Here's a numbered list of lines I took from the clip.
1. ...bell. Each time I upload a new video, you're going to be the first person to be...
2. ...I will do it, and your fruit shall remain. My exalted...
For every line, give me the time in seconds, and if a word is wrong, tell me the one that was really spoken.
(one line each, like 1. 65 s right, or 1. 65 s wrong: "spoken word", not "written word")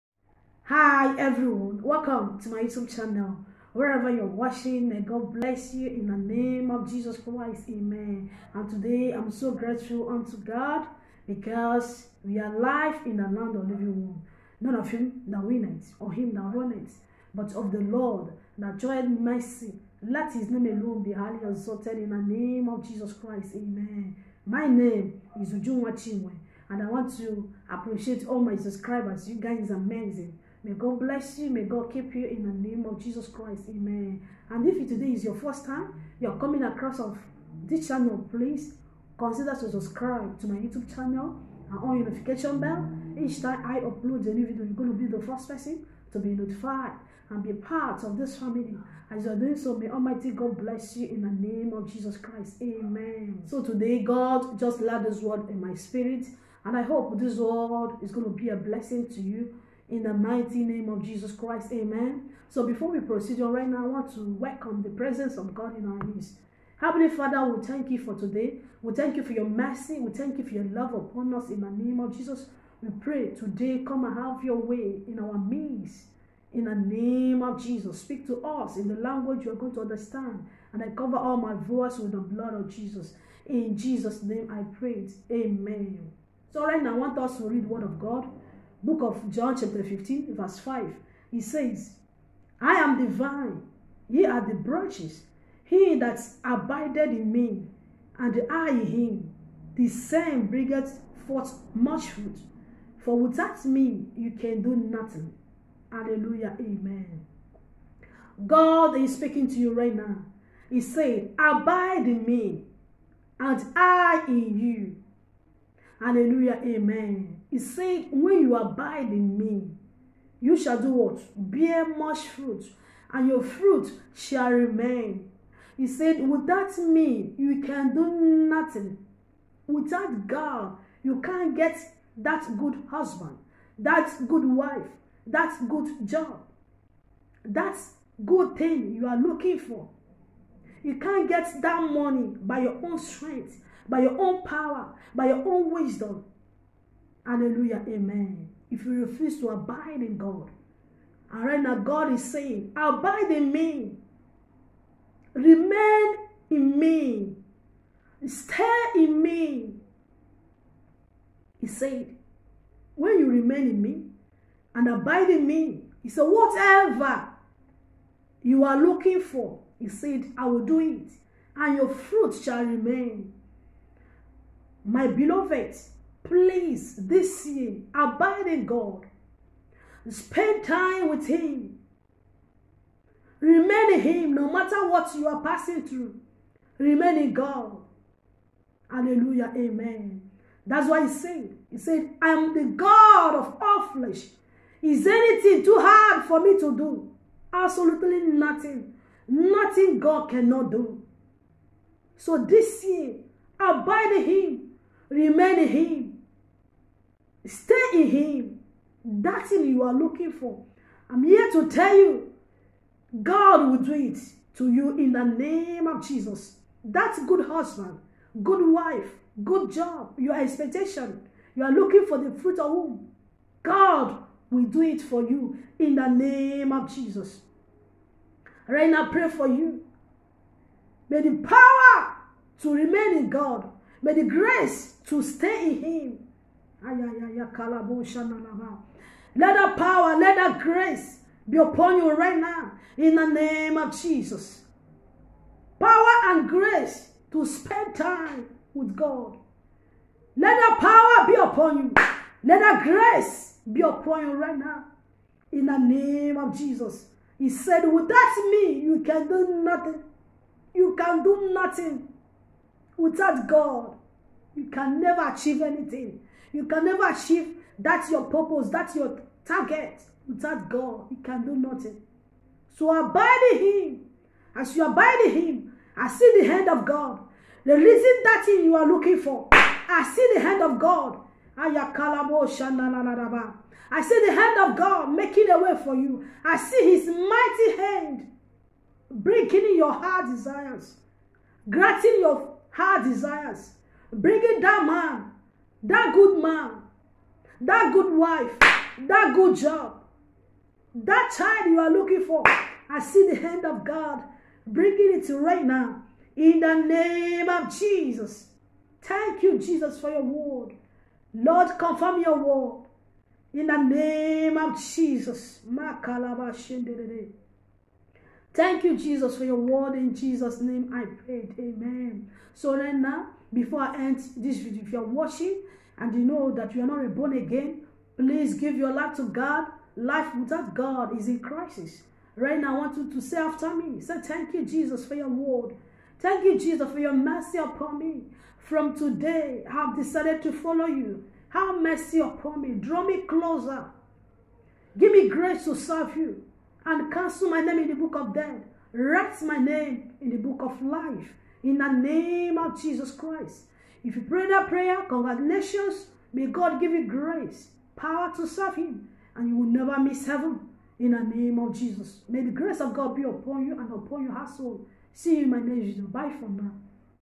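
1. 42 s right
2. 170 s wrong: "beloved", not "exalted".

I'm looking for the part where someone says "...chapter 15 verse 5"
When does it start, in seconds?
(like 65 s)
89 s.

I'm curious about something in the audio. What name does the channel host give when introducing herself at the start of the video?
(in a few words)
Ujunwa Chinwe.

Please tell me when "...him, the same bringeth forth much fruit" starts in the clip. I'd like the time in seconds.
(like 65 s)
98 s.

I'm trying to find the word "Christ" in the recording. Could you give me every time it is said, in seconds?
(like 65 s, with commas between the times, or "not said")
7 s, 23 s, 33 s, 52 s, 61 s, 353 s.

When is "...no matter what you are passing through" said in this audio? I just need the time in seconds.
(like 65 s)
184 s.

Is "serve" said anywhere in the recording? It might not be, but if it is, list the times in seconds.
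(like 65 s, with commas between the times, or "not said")
345 s, 358 s.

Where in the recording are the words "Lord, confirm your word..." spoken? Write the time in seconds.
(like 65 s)
311 s.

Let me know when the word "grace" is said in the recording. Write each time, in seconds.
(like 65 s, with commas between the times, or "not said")
234 s, 240 s, 246 s, 252 s, 345 s, 357 s, 362 s.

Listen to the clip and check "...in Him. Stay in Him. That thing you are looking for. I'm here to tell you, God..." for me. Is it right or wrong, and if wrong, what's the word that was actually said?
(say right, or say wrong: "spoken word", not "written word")
right.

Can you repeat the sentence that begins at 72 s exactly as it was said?
We pray today, come and have your way in our midst.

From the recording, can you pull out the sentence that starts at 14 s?
None of him that win it or him that run it, but of the Lord that joyed mercy.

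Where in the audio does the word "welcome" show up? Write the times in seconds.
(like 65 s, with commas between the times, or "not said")
1 s, 64 s.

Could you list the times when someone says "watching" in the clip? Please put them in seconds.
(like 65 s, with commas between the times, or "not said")
4 s, 325 s.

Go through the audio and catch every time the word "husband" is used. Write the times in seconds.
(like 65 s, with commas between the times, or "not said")
132 s, 217 s.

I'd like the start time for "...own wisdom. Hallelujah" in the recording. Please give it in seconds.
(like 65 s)
145 s.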